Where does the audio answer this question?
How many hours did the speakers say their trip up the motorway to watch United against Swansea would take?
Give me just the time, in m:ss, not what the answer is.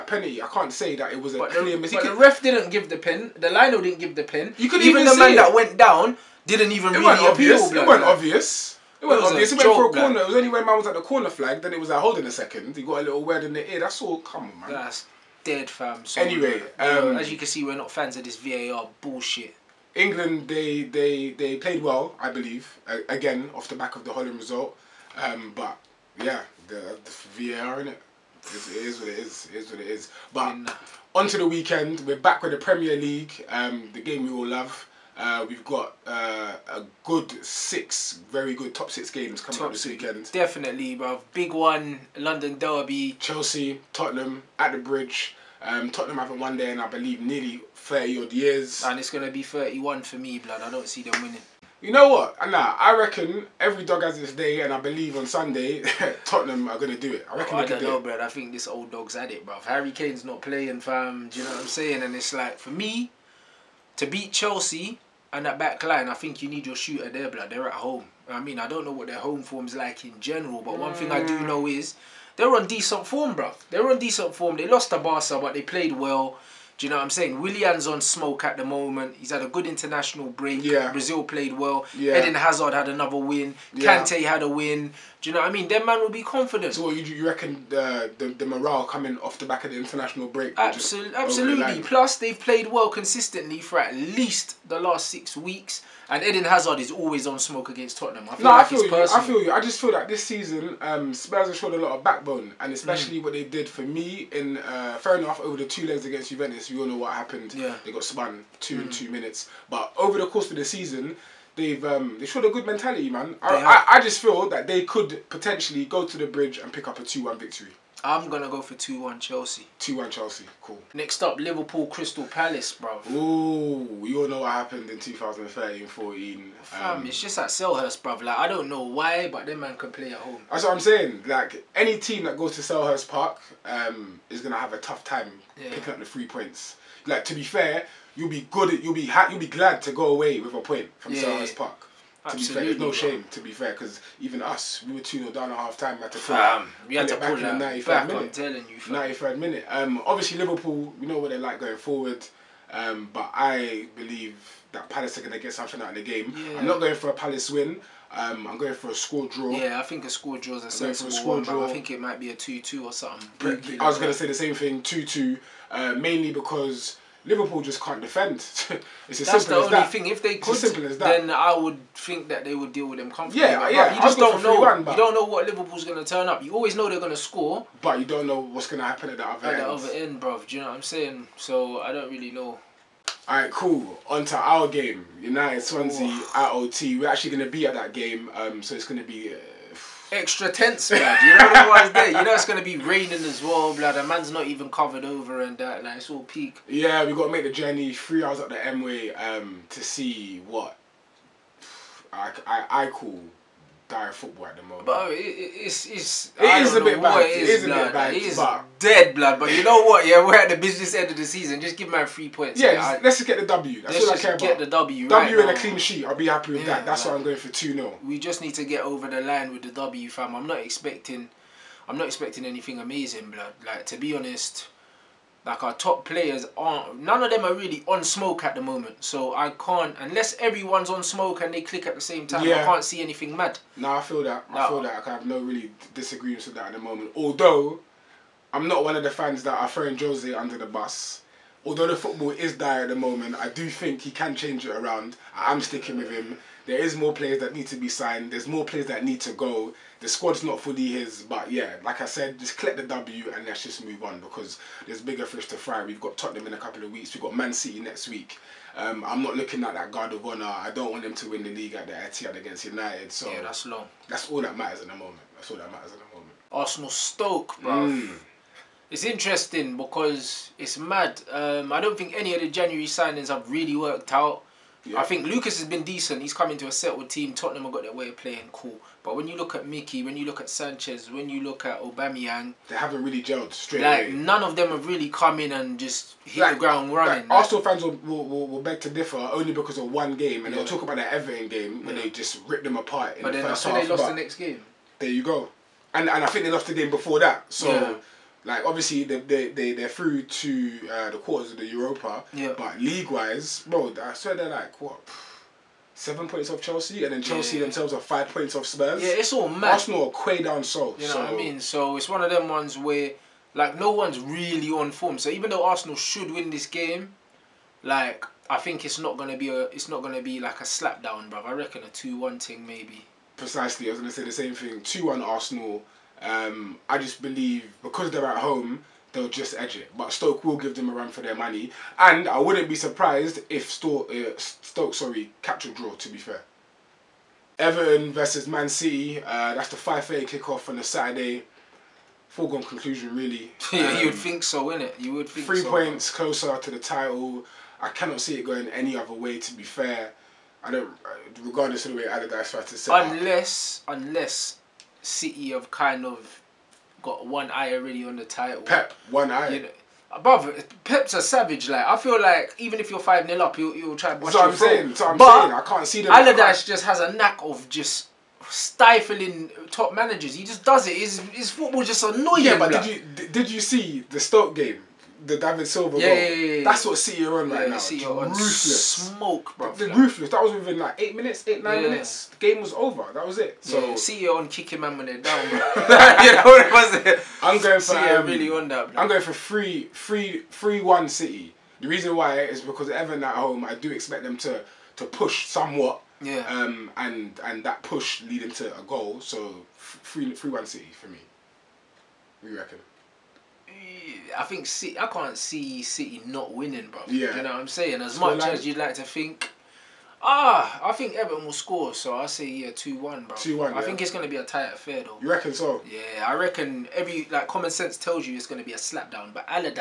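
3:17.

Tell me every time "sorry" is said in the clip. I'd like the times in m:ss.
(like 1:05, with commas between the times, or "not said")
5:34.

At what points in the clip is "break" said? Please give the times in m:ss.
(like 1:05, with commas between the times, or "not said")
1:20, 1:30.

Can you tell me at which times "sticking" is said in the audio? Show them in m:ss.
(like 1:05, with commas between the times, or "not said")
4:05.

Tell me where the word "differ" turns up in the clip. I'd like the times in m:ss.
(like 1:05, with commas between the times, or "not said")
4:48.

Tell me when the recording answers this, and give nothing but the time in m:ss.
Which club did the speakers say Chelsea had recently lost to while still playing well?
1:14.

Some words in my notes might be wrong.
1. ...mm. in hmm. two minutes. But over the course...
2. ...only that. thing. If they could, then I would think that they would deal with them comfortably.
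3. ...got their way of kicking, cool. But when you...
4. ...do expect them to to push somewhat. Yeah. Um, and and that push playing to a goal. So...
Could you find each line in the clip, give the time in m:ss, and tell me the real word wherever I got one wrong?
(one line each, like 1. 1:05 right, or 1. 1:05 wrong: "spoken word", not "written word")
1. 1:48 right
2. 2:49 right
3. 4:37 wrong: "playing", not "kicking"
4. 6:33 wrong: "leading", not "playing".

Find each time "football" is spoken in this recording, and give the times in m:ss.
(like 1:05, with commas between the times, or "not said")
3:24, 4:01, 6:11.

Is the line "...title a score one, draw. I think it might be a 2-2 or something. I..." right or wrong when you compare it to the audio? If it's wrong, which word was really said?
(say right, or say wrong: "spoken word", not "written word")
wrong: "sensible", not "title".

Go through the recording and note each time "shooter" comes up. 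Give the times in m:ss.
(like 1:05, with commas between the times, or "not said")
1:06.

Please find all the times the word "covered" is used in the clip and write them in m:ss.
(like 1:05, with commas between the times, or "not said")
3:14.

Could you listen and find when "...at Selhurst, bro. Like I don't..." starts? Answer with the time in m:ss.
2:07.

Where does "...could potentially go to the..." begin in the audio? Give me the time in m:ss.
1:54.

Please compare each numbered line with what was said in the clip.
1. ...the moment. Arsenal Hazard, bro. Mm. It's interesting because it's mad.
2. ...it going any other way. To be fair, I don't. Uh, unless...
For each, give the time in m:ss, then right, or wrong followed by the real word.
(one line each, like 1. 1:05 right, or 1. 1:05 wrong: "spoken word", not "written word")
1. 4:25 wrong: "Stoke", not "Hazard"
2. 5:48 wrong: "regardless", not "unless".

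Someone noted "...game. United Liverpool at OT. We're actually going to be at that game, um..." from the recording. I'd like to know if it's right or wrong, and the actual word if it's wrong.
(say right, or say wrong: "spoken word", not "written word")
wrong: "Swansea", not "Liverpool".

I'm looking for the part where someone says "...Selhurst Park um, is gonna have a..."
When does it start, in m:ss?
2:12.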